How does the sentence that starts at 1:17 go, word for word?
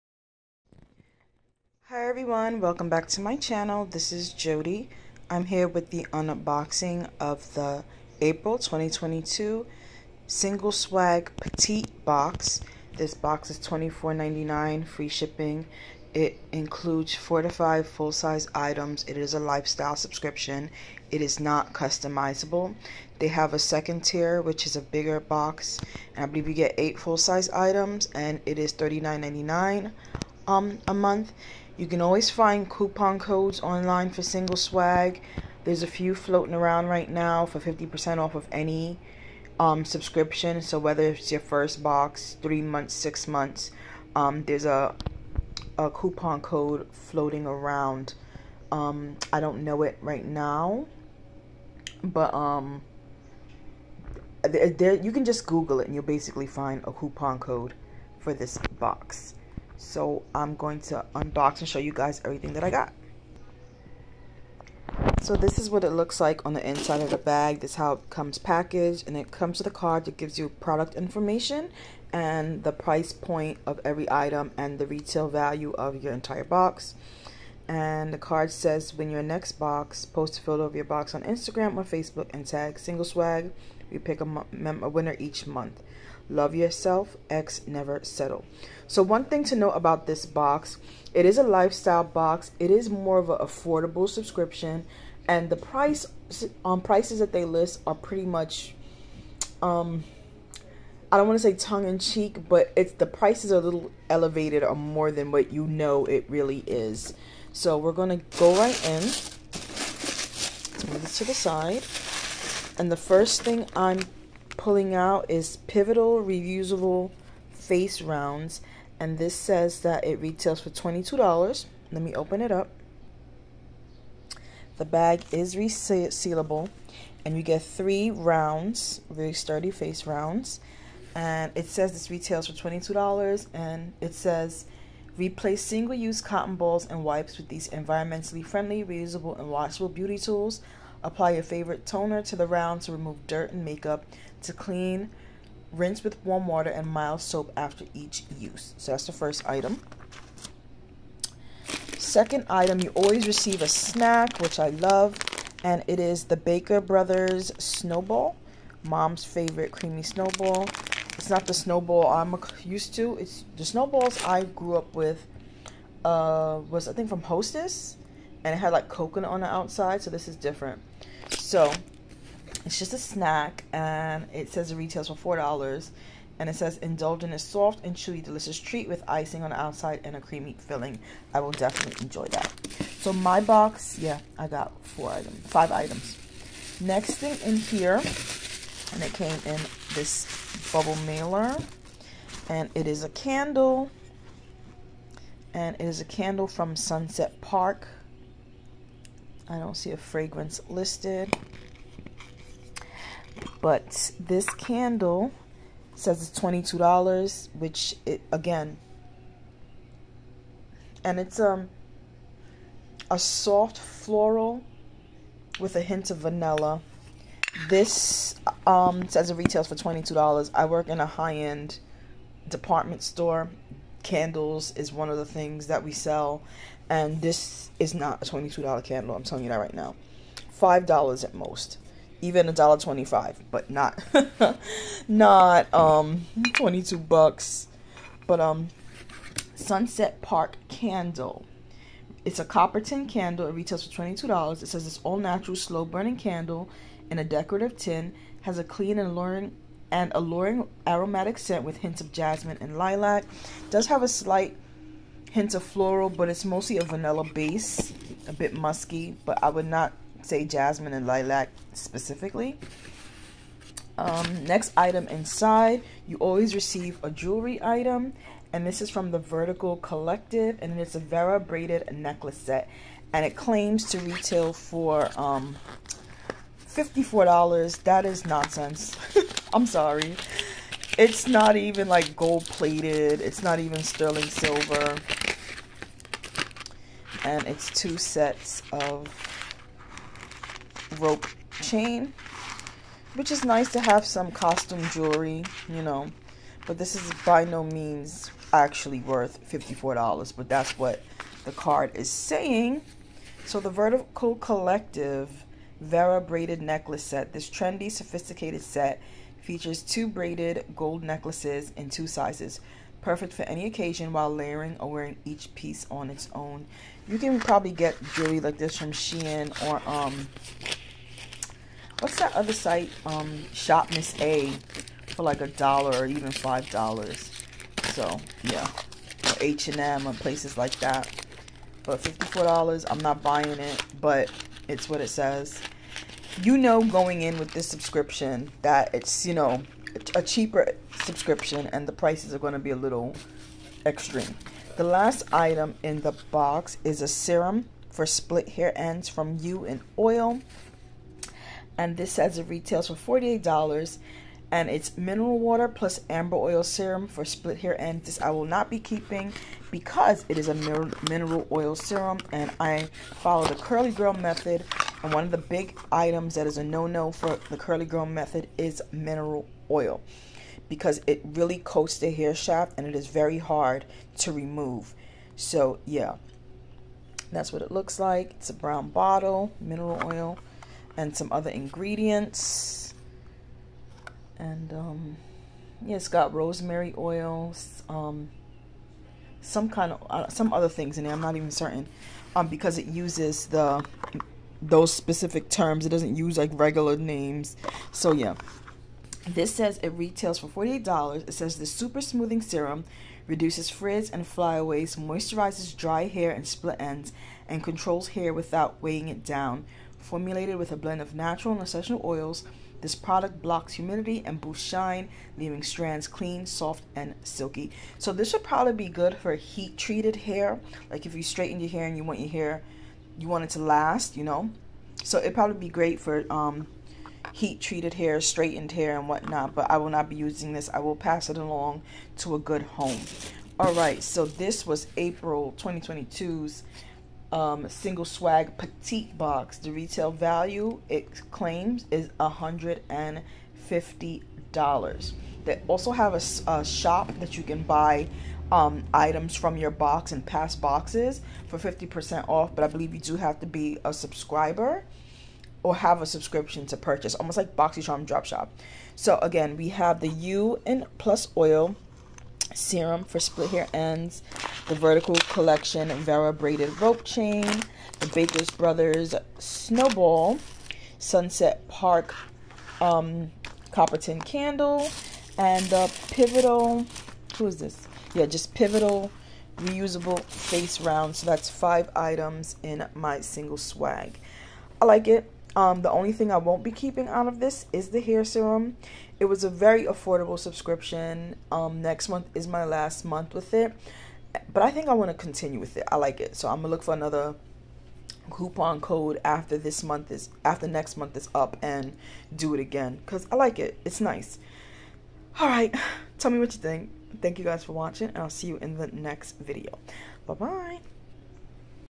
And the card says when your next box, post a photo of your box on Instagram or Facebook and tag single swag.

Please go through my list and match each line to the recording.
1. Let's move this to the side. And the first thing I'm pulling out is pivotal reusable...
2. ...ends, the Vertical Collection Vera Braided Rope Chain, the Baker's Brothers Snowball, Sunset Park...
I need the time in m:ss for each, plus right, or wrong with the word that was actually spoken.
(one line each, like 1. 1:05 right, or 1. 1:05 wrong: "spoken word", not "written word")
1. 1:49 right
2. 7:43 right.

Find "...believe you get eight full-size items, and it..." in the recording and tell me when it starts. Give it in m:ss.
0:26.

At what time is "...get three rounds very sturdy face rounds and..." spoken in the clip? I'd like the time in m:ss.
2:07.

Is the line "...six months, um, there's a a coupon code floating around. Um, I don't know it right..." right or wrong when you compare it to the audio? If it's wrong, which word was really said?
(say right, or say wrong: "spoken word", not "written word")
right.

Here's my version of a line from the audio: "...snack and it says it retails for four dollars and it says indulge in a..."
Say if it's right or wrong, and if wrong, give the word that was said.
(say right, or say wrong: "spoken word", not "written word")
right.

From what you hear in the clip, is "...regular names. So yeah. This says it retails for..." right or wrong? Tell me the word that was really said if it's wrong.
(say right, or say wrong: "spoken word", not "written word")
right.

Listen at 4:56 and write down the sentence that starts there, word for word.
But this is by no means actually worth $54, but that's what the card is saying.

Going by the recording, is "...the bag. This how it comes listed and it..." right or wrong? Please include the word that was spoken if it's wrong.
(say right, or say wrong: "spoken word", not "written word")
wrong: "packaged", not "listed".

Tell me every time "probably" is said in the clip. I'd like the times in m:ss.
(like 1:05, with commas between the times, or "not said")
5:17, 6:58, 7:05.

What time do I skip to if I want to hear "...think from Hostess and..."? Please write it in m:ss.
2:46.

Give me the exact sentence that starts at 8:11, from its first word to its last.
Um, next month is my last month with it.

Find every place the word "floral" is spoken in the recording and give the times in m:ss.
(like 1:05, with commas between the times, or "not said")
3:33, 4:15.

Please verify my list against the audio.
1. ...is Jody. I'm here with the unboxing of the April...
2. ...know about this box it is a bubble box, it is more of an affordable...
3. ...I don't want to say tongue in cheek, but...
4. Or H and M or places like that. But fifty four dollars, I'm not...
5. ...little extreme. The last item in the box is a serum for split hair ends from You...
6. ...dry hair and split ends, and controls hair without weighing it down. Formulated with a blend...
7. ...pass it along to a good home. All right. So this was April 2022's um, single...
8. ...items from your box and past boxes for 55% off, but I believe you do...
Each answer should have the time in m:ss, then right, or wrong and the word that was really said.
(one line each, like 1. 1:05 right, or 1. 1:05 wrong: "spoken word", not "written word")
1. 0:04 right
2. 1:29 wrong: "lifestyle", not "bubble"
3. 1:41 right
4. 5:29 right
5. 5:42 right
6. 6:45 right
7. 7:10 right
8. 7:28 wrong: "50", not "55".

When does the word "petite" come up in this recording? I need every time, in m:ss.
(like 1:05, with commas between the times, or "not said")
0:11, 7:18.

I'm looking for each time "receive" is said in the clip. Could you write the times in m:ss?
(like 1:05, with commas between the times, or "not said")
2:33, 4:26.